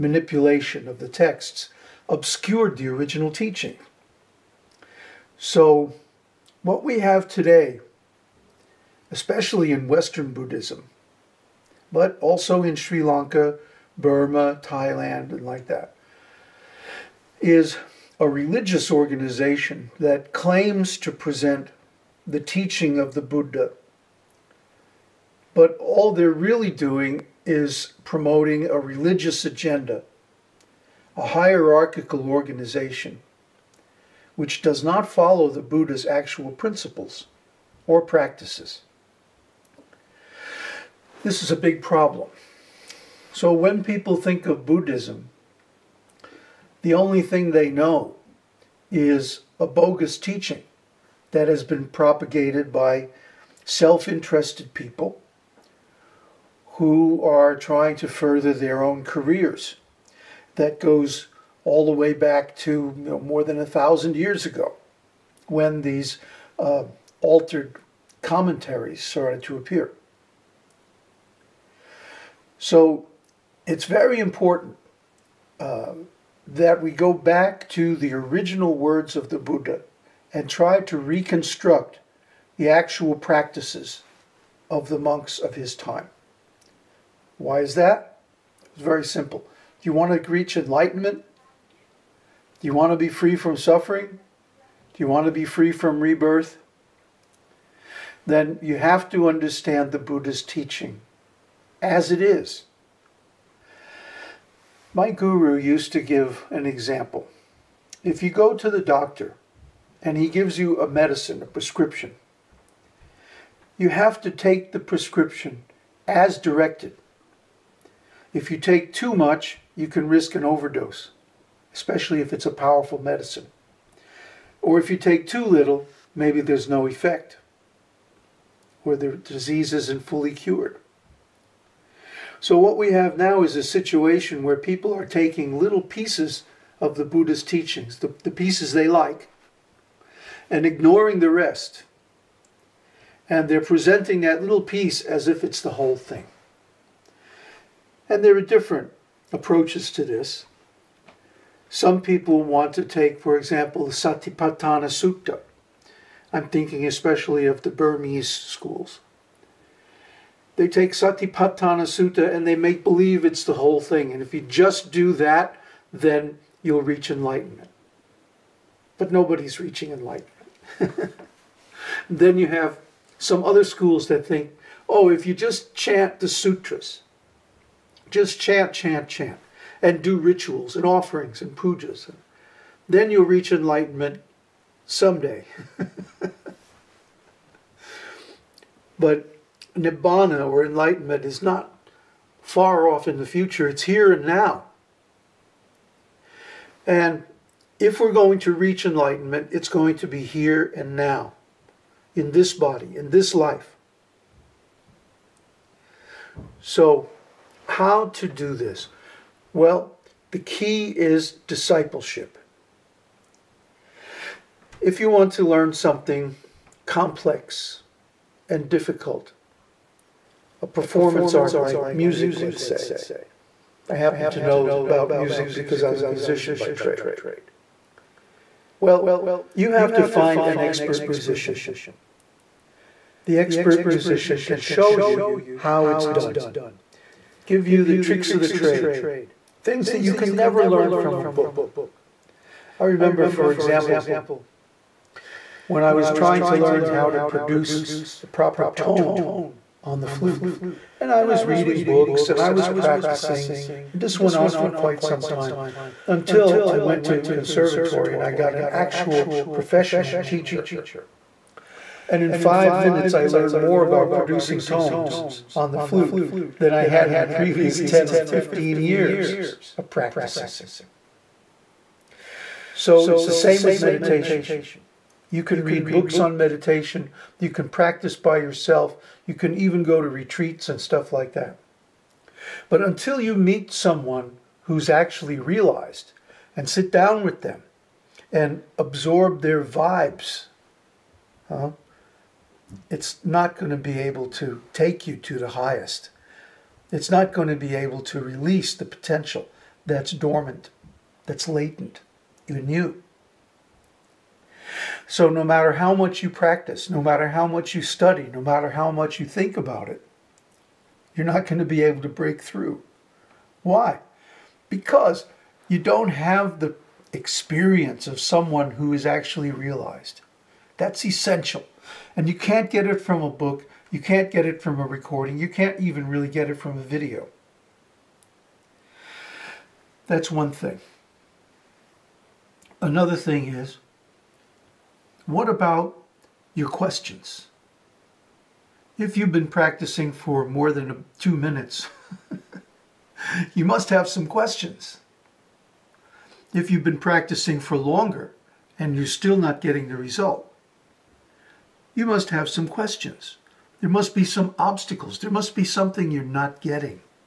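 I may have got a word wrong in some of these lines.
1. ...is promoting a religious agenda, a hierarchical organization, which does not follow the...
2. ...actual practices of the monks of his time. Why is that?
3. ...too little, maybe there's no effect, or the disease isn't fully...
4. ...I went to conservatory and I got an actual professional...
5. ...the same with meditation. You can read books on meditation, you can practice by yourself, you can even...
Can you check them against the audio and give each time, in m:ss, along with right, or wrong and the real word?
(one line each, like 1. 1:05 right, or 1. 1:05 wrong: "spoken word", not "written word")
1. 0:27 right
2. 1:22 right
3. 2:05 right
4. 4:16 right
5. 4:33 right.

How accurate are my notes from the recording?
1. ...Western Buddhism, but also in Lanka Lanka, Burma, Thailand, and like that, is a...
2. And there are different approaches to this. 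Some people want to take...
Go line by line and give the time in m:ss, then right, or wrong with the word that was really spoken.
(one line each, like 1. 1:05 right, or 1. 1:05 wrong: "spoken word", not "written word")
1. 0:09 wrong: "Sri", not "Lanka"
2. 2:28 right.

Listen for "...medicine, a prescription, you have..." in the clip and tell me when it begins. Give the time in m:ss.
1:50.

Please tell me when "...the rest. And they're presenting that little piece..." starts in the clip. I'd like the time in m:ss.
2:21.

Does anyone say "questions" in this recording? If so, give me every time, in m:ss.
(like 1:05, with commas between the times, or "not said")
5:36, 5:44, 5:52.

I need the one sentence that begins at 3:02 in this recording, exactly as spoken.
And then you'll reach enlightenment someday.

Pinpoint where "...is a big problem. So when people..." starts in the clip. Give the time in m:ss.
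0:41.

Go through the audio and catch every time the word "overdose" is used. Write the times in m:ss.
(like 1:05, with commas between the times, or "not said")
2:00.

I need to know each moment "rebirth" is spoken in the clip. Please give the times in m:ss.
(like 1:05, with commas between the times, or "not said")
1:35.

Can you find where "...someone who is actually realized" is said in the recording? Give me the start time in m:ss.
5:18.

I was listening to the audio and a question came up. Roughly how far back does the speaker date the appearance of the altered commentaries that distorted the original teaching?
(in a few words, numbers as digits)
more than 1,000 years ago.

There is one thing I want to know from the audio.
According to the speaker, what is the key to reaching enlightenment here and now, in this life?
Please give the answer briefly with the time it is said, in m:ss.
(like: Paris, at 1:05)
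discipleship, at 3:31.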